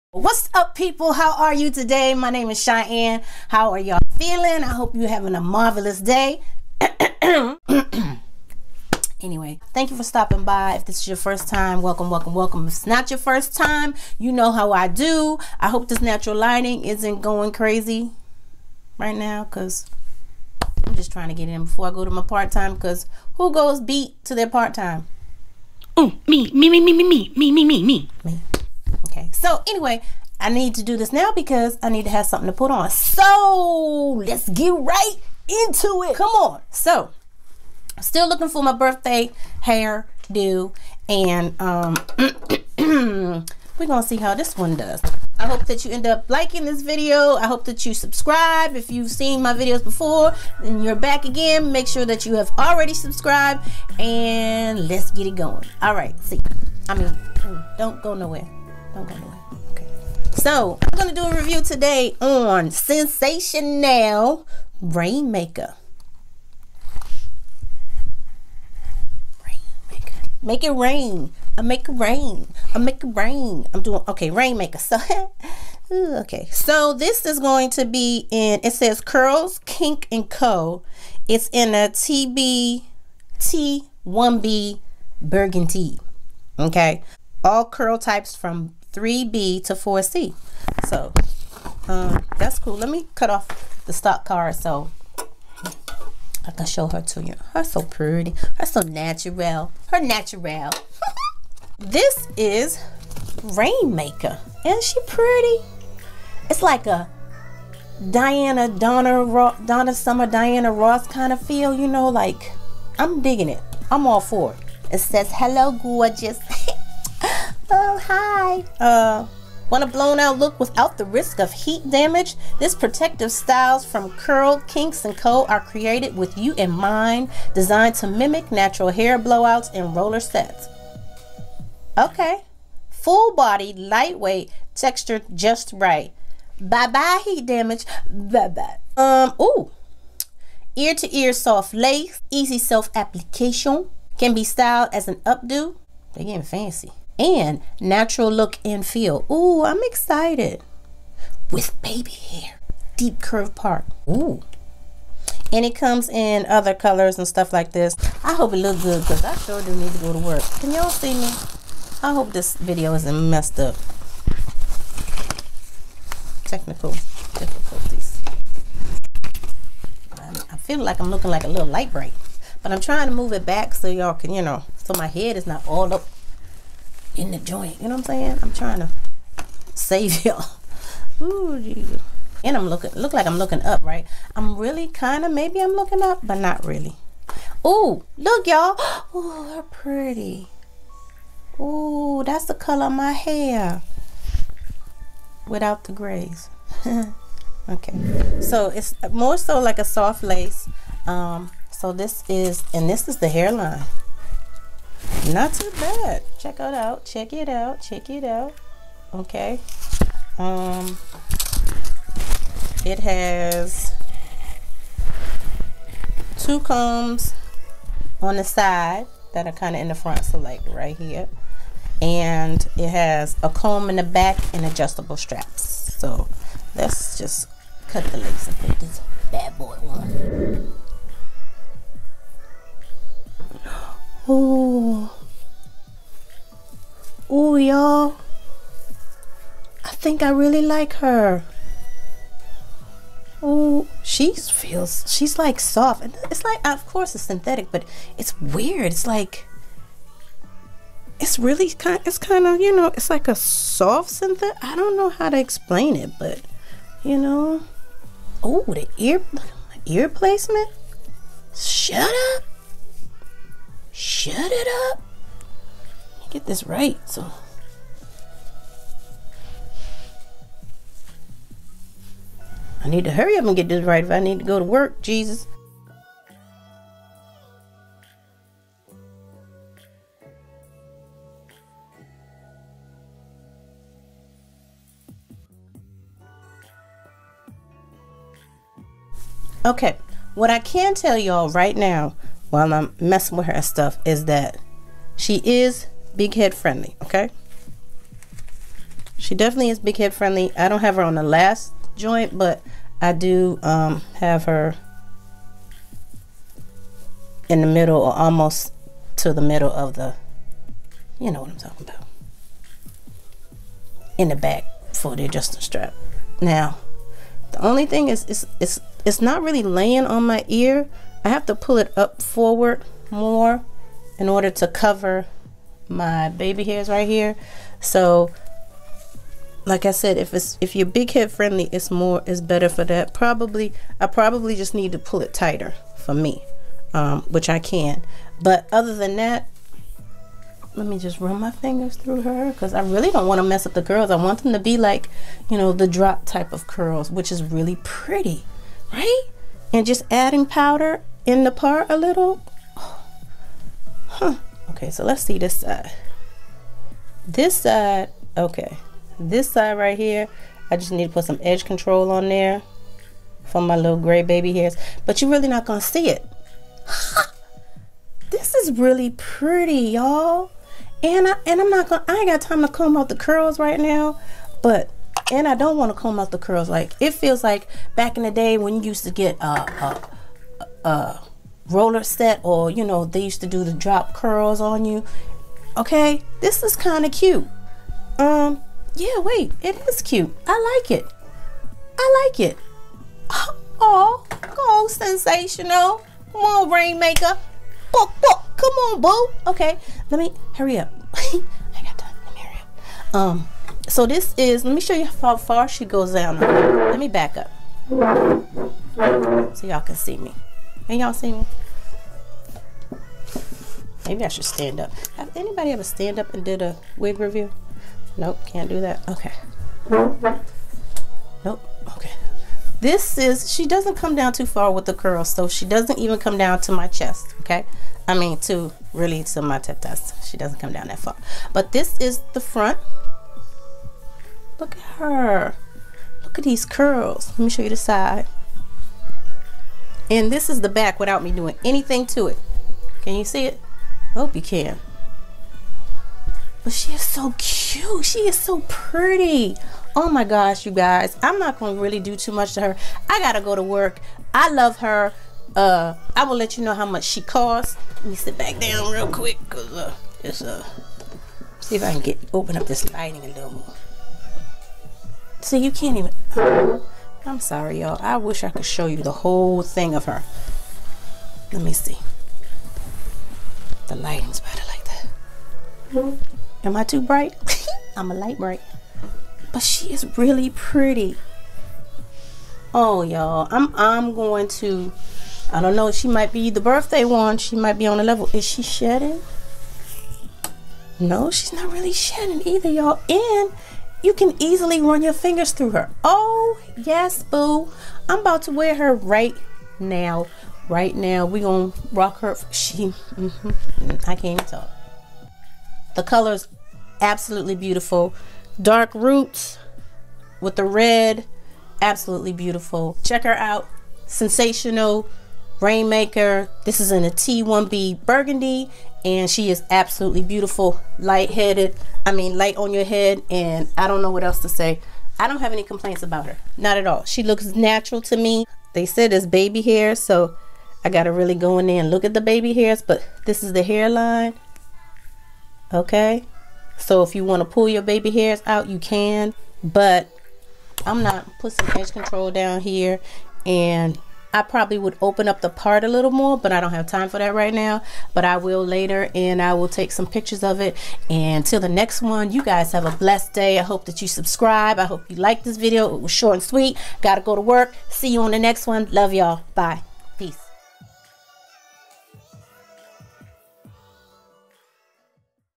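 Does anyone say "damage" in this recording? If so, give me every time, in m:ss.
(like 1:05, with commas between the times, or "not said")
2:01, 2:17.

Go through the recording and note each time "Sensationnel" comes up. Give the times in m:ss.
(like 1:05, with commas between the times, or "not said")
1:02, 6:34, 8:34.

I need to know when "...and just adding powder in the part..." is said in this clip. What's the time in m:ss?
5:49.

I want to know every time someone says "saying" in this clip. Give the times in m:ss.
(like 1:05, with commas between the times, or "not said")
2:58.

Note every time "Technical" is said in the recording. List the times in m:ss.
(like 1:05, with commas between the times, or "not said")
2:46.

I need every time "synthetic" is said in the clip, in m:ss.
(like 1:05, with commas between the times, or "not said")
4:07, 4:14.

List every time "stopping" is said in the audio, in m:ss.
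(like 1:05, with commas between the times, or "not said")
0:10.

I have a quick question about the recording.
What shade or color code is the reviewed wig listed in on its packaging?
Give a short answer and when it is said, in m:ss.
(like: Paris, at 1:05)
T1B burgundy, at 1:21.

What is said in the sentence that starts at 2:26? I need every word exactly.
They getting fancy and natural look and feel.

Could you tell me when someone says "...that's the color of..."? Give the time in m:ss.
3:12.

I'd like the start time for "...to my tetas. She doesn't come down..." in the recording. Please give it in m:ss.
7:09.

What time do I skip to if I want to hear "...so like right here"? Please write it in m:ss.
3:40.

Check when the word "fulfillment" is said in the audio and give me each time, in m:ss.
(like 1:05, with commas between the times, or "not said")
not said.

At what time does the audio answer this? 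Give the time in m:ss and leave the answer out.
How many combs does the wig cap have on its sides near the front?
3:36.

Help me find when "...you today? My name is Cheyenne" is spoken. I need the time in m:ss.
0:01.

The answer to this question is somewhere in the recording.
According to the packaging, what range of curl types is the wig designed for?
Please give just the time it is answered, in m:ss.
1:28.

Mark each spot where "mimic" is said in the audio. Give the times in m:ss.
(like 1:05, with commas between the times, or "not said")
2:08.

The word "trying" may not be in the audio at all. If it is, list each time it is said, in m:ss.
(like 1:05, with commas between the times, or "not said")
0:21, 2:52, 2:58.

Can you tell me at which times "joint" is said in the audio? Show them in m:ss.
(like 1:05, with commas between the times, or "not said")
2:57, 5:01.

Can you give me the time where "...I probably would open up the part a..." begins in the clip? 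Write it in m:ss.
9:04.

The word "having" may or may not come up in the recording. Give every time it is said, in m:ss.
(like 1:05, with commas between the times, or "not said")
0:05.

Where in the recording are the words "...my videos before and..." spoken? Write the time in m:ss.
0:49.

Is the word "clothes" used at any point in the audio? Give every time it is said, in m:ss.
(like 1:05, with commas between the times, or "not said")
not said.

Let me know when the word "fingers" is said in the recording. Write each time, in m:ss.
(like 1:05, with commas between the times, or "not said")
5:41, 8:15.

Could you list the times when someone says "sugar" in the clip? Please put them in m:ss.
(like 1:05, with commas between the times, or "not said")
not said.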